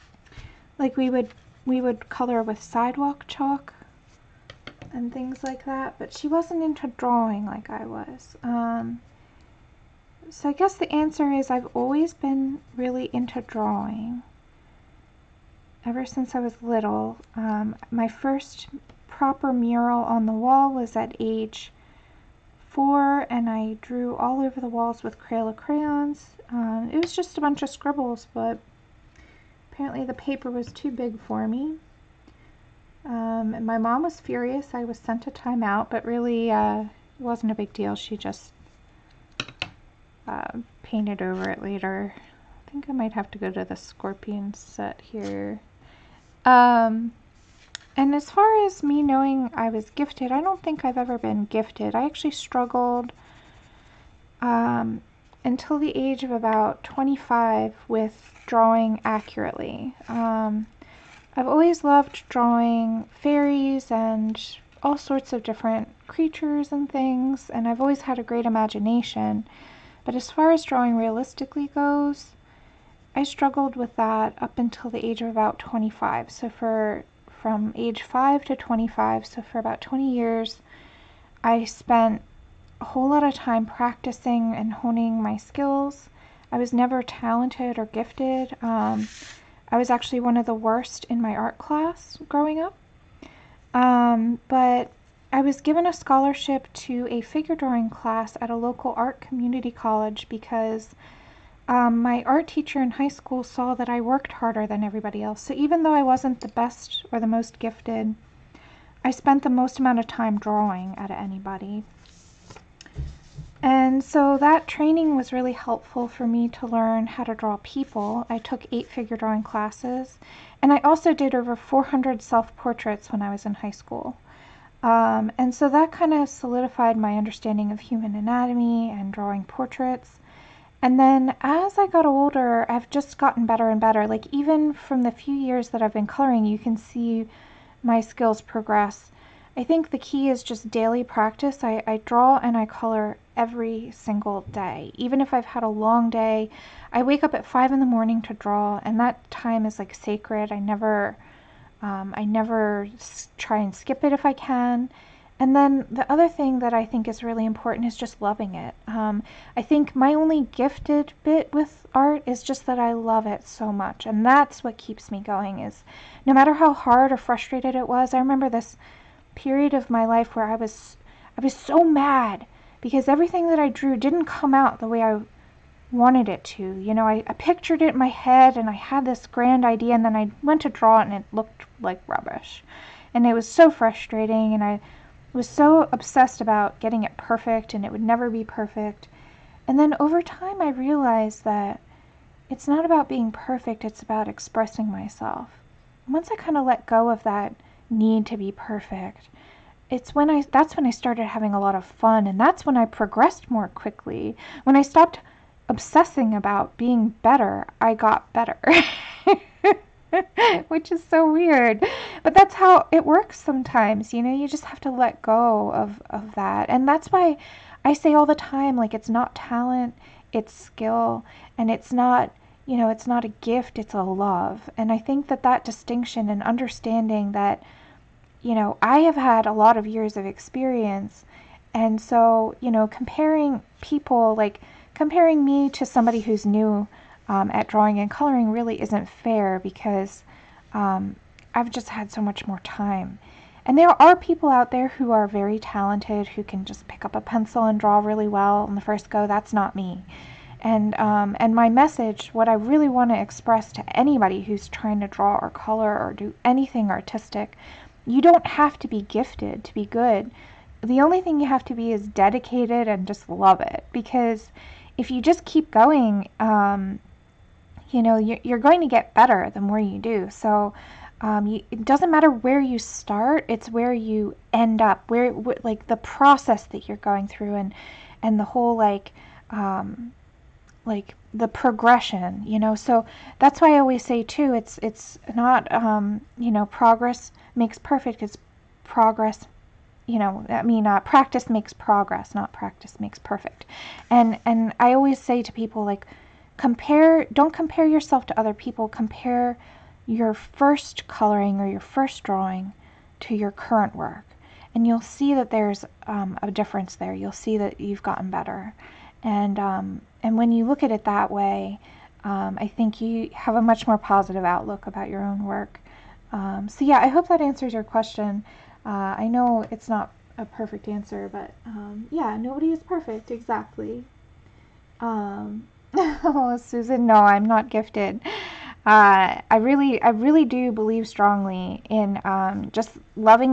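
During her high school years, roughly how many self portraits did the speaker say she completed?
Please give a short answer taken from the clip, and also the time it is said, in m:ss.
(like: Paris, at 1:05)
400, at 2:01.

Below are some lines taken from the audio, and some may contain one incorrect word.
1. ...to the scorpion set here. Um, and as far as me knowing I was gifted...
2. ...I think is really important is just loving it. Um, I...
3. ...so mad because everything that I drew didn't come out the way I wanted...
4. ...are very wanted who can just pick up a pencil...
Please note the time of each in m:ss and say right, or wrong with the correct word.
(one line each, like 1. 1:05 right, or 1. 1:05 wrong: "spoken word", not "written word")
1. 0:43 right
2. 2:36 right
3. 2:51 right
4. 4:05 wrong: "talented", not "wanted".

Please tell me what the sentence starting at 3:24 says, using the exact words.
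When I stopped obsessing about being better, I got better.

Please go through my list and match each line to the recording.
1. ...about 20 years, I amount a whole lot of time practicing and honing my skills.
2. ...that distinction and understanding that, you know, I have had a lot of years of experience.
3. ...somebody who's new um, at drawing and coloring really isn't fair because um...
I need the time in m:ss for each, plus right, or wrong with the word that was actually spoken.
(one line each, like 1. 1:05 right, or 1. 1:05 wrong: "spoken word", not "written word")
1. 1:19 wrong: "spent", not "amount"
2. 3:45 right
3. 3:55 right.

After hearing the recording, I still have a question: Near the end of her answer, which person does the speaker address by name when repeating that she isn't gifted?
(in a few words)
Susan.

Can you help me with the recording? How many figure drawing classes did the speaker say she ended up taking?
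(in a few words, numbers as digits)
8.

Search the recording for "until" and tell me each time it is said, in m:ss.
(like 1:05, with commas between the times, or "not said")
0:55, 1:14.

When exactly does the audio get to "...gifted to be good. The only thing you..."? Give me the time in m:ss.
4:19.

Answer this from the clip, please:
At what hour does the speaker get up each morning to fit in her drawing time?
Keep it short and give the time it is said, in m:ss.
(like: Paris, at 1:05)
5 in the morning, at 2:27.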